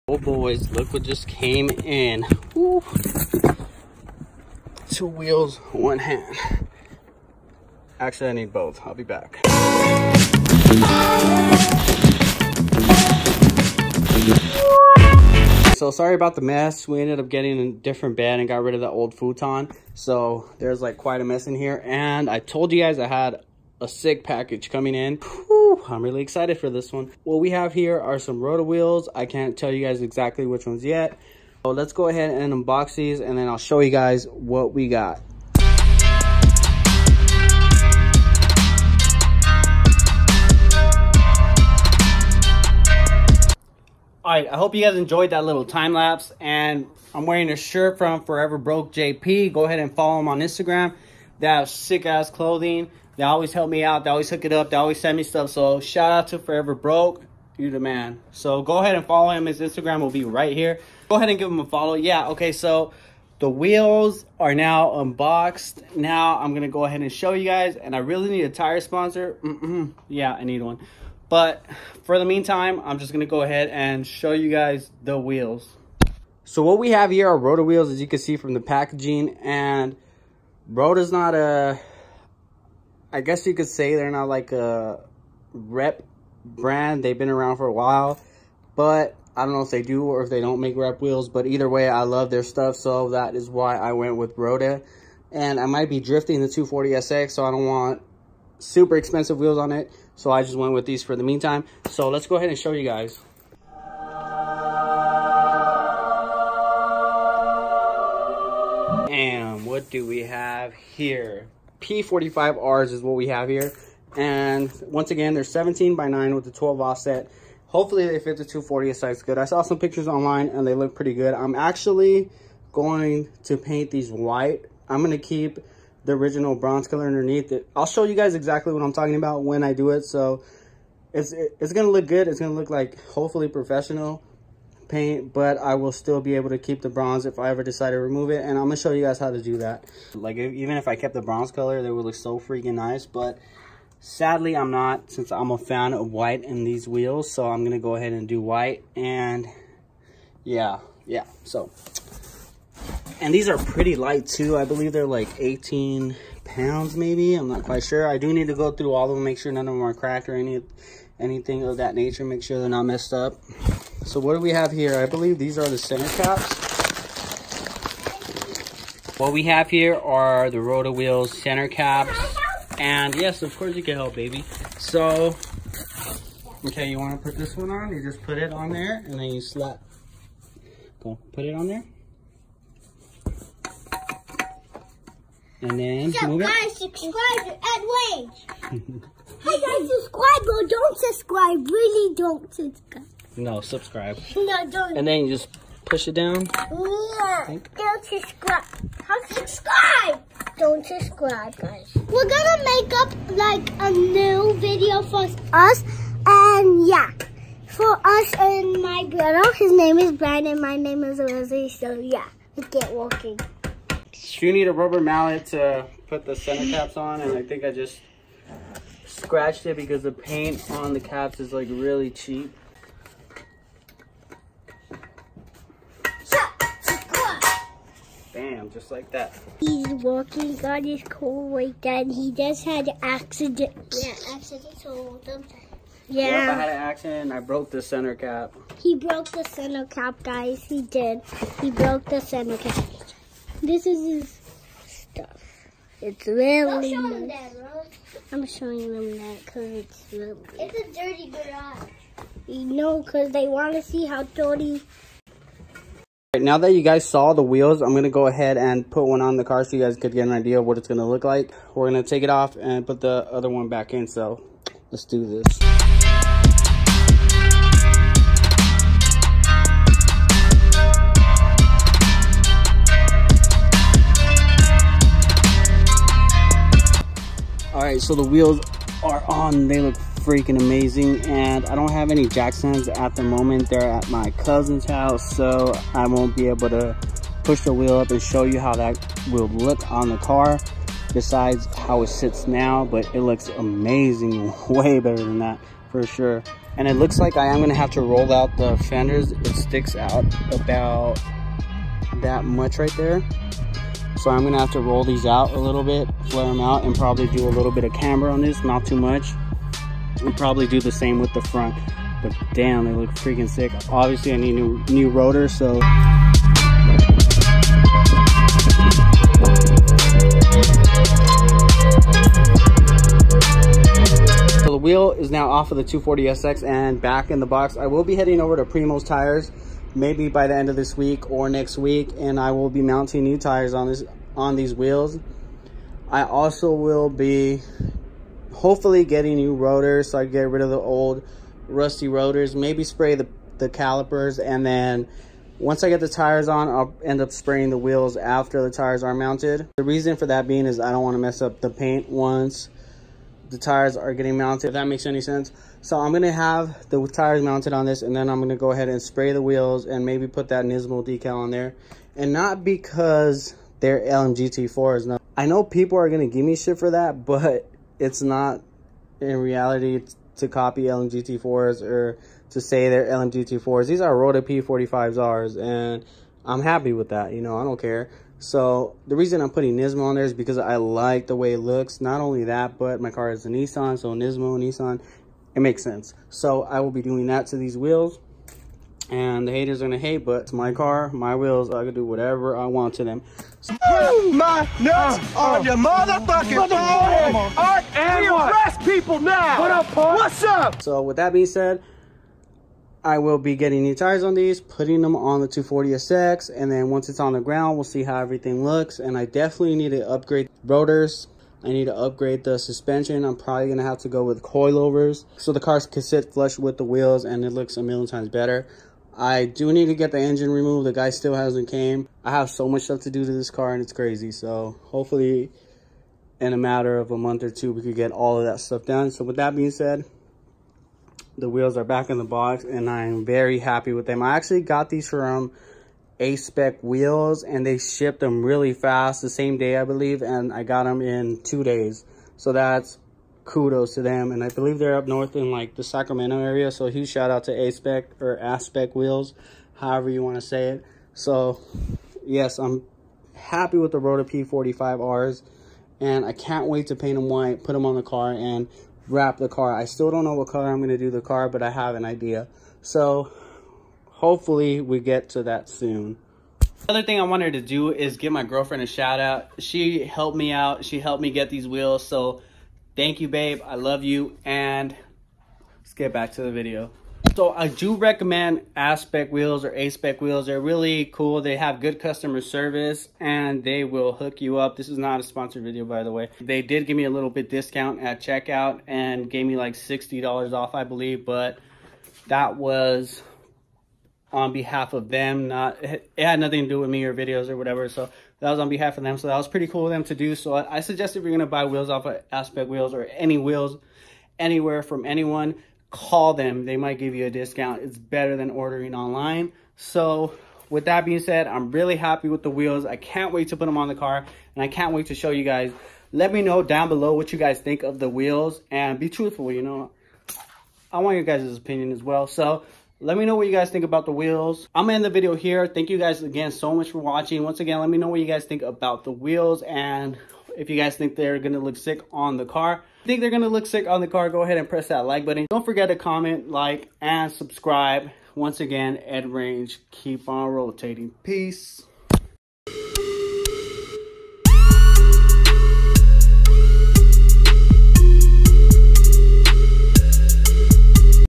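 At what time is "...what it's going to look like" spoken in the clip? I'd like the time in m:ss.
4:20.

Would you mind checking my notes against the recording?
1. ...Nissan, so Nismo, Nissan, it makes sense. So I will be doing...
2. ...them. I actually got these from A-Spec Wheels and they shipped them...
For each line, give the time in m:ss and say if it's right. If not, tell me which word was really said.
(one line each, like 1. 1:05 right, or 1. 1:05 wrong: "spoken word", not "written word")
1. 6:23 right
2. 7:14 right.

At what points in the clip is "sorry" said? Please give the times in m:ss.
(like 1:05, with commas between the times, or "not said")
0:15.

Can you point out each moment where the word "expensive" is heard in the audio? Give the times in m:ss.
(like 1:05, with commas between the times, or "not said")
1:38.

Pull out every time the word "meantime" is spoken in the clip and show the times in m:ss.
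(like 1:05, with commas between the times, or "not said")
1:12, 1:41.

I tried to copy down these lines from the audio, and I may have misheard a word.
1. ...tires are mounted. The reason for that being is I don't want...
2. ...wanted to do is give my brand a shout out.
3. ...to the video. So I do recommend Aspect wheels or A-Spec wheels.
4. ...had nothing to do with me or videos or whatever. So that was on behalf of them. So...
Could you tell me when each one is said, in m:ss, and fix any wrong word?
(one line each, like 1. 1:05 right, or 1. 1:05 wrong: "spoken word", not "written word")
1. 5:48 right
2. 7:47 wrong: "girlfriend", not "brand"
3. 7:56 right
4. 8:16 right.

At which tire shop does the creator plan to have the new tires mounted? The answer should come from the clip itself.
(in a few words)
Primo's Tires.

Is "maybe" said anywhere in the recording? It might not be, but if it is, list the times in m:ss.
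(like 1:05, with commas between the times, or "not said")
2:36, 5:29, 5:42, 6:00.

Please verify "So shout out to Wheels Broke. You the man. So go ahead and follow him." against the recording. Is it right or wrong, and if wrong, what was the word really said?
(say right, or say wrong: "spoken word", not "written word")
wrong: "Forever", not "Wheels".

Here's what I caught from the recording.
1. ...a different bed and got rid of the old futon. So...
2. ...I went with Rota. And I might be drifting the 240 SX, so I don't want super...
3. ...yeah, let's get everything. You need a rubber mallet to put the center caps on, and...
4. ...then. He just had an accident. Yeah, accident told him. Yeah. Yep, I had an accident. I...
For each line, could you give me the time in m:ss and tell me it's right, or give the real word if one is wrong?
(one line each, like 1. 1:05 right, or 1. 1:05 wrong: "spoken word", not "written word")
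1. 0:17 right
2. 1:33 right
3. 3:31 wrong: "walking", not "everything"
4. 3:51 right.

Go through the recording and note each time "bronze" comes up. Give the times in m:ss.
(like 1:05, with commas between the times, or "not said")
2:06, 2:16, 2:21.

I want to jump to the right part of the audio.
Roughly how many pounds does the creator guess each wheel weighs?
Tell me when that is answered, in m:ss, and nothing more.
2:35.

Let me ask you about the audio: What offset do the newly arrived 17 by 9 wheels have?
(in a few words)
12.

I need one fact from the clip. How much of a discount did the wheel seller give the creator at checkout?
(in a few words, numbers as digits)
$60.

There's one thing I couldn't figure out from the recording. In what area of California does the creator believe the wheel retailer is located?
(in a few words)
Sacramento.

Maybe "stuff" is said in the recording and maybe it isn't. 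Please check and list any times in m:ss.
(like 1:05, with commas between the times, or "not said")
0:55, 1:32, 4:04, 7:02, 7:08.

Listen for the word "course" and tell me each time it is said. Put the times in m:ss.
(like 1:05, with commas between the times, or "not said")
2:53.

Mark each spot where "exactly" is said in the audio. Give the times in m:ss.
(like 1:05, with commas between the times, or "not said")
0:30, 2:08.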